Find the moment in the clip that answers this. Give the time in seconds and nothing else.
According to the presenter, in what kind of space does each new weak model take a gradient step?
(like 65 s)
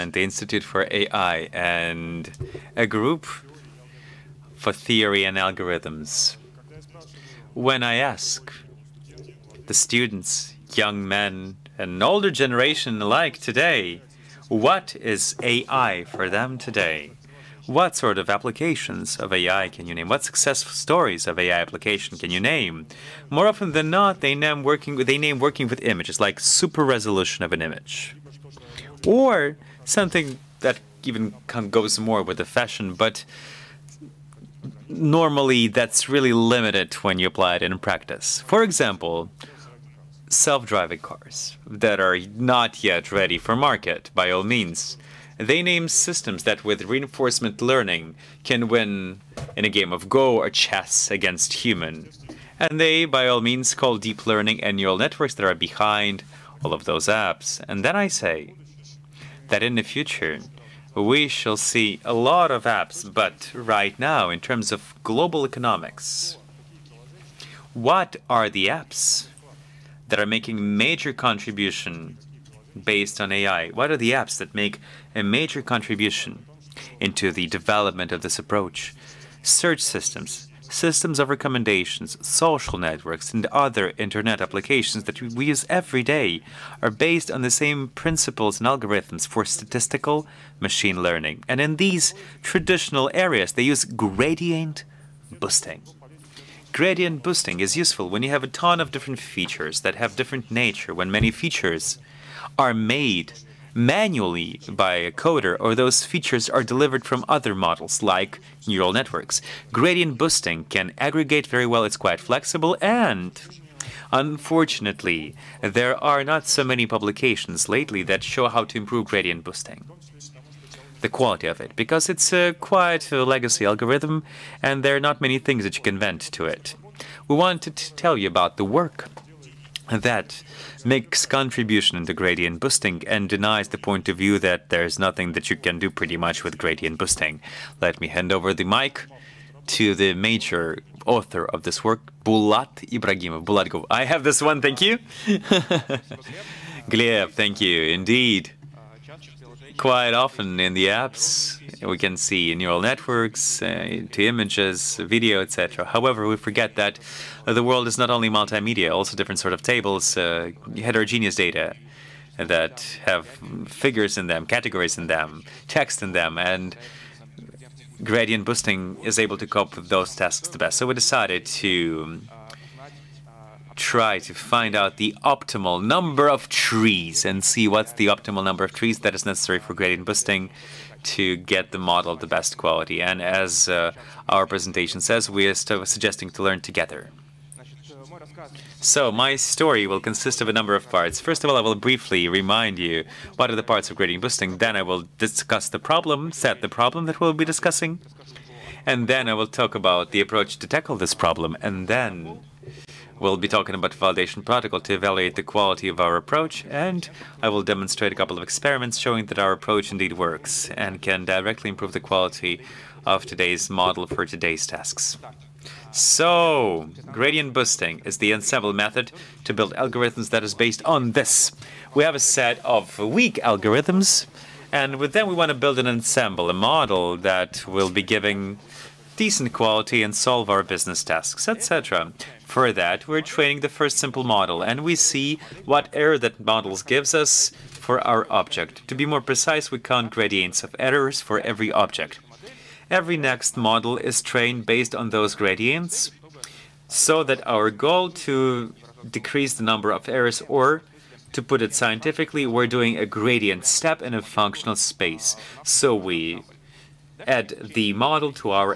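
254 s.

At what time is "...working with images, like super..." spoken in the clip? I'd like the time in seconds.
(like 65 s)
25 s.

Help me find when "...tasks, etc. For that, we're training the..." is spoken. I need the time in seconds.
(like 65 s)
231 s.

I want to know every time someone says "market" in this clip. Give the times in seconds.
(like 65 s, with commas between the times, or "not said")
43 s.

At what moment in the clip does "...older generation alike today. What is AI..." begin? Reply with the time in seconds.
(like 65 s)
12 s.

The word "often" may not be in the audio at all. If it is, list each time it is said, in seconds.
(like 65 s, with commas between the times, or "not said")
23 s, 150 s.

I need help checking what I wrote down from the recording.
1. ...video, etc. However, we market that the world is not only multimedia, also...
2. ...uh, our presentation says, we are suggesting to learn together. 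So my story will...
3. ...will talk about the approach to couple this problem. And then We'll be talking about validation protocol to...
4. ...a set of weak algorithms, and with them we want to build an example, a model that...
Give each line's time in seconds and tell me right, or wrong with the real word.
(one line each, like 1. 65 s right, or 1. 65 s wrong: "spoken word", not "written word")
1. 154 s wrong: "forget", not "market"
2. 183 s right
3. 199 s wrong: "tackle", not "couple"
4. 222 s wrong: "ensemble", not "example".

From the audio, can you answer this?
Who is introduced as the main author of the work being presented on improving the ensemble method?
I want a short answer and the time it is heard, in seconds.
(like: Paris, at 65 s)
Bulat Ibragimov, at 142 s.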